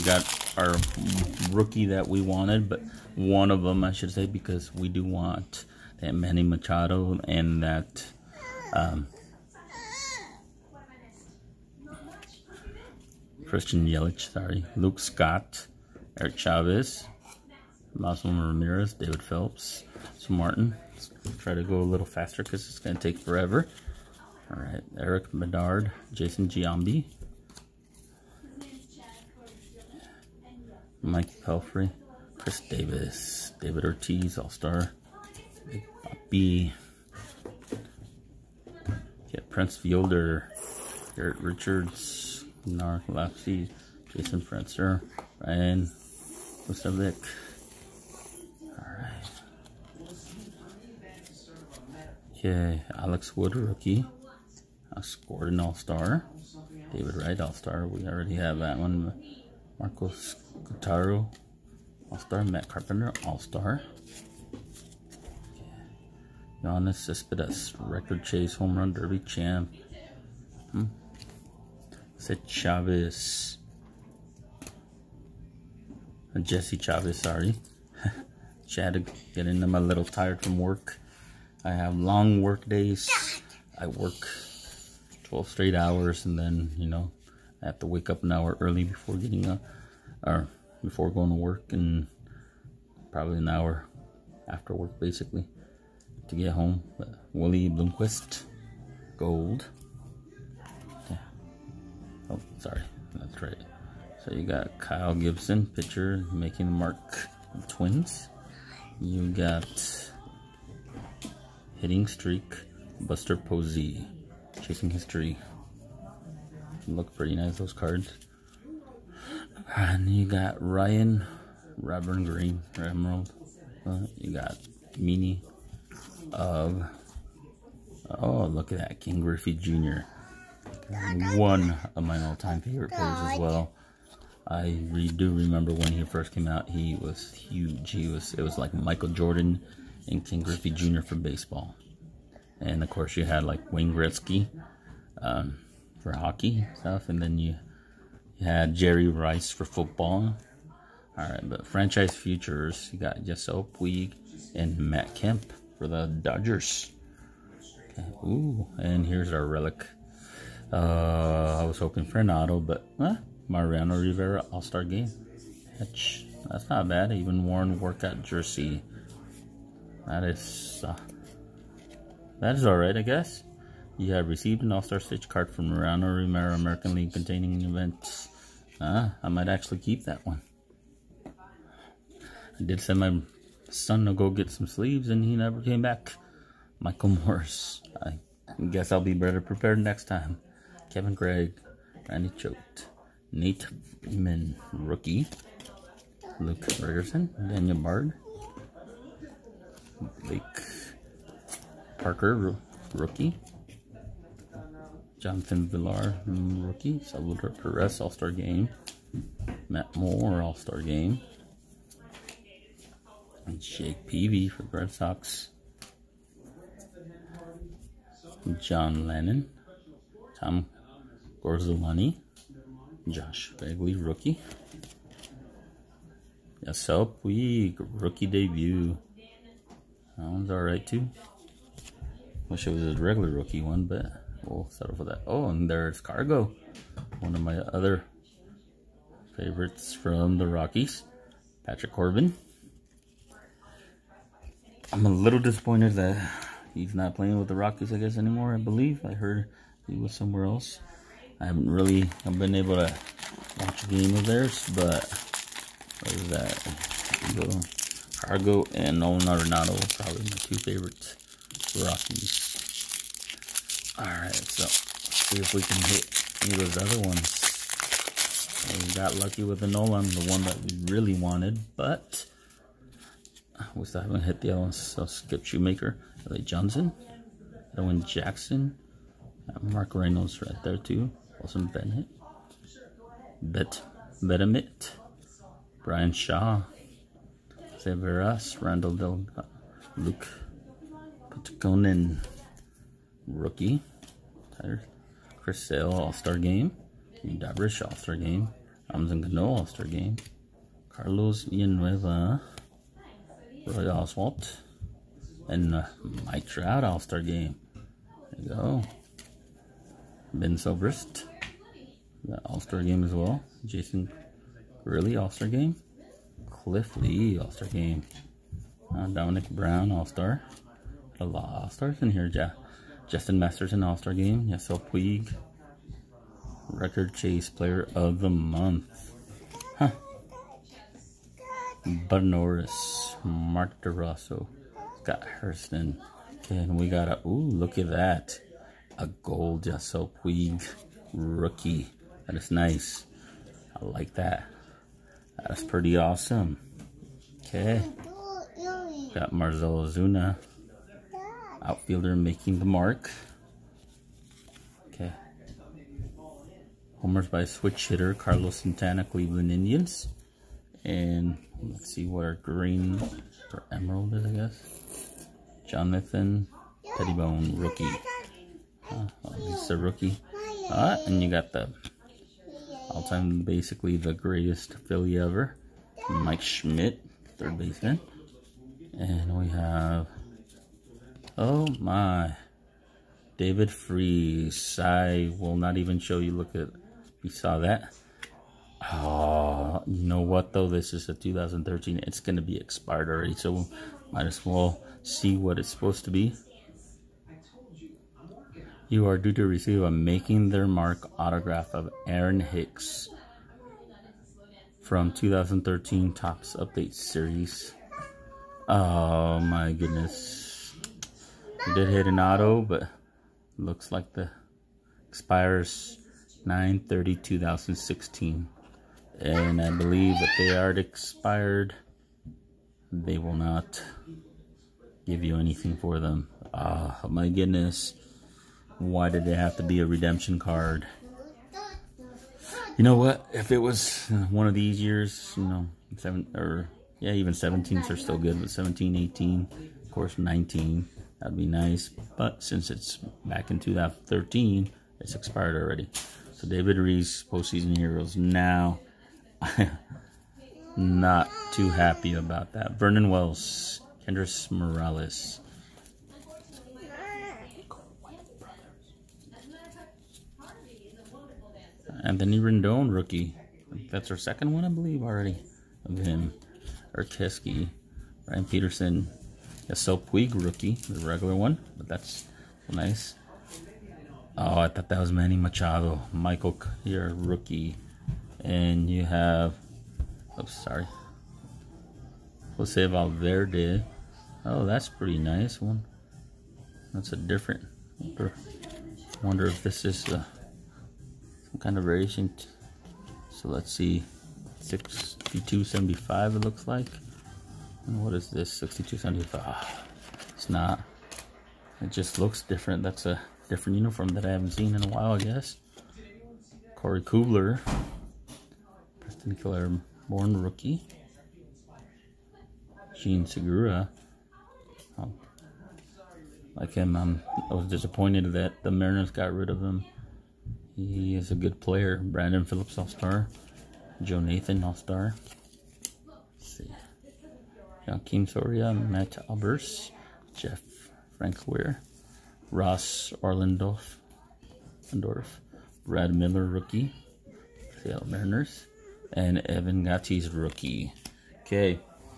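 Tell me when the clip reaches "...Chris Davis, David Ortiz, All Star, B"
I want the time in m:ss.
0:32.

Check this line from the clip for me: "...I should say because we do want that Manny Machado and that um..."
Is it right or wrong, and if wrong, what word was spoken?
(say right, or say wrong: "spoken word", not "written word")
right.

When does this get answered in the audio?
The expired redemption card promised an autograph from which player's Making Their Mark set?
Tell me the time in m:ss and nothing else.
6:42.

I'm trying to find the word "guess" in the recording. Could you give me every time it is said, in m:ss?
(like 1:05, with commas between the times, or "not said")
2:53, 3:08, 4:07, 6:04, 8:25.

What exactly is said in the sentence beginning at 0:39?
Yeah, Prince Fielder, Garrett Richards, Narcolepsy, Jason Frenzer, Ryan Kosovic.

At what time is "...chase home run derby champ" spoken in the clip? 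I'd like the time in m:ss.
1:08.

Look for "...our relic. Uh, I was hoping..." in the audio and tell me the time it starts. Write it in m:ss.
2:39.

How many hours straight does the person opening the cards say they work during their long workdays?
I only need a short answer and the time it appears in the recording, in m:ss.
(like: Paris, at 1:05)
12, at 1:25.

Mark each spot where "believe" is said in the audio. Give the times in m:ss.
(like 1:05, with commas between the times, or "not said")
4:08, 6:59, 7:44.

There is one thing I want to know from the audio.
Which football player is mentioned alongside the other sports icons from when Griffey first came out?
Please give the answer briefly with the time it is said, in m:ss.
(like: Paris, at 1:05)
Jerry Rice, at 2:28.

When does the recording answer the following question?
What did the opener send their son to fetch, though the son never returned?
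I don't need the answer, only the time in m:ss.
3:04.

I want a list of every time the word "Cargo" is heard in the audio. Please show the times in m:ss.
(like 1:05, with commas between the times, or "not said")
3:55, 4:18.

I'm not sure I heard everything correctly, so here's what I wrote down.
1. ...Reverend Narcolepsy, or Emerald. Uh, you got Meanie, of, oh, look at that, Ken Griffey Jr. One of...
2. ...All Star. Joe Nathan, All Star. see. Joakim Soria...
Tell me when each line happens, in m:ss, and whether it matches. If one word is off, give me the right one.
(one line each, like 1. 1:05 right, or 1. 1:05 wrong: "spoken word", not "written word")
1. 2:01 wrong: "Green", not "Narcolepsy"
2. 8:42 right.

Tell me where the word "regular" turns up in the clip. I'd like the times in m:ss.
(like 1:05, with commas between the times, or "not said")
3:53, 7:51.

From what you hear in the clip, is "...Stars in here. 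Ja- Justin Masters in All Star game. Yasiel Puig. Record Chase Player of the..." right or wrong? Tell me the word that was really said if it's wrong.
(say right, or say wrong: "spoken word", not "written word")
right.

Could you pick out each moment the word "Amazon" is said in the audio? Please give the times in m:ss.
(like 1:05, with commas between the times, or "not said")
4:58.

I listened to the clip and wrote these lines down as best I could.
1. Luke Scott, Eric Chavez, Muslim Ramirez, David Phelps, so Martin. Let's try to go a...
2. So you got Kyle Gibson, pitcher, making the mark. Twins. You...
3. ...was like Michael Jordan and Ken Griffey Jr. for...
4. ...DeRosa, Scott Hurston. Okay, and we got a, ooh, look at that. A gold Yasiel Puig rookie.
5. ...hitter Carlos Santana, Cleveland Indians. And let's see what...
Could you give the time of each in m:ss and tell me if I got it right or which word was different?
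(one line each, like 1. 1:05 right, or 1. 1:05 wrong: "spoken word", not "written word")
1. 0:14 right
2. 1:44 right
3. 2:18 right
4. 5:33 right
5. 5:57 right.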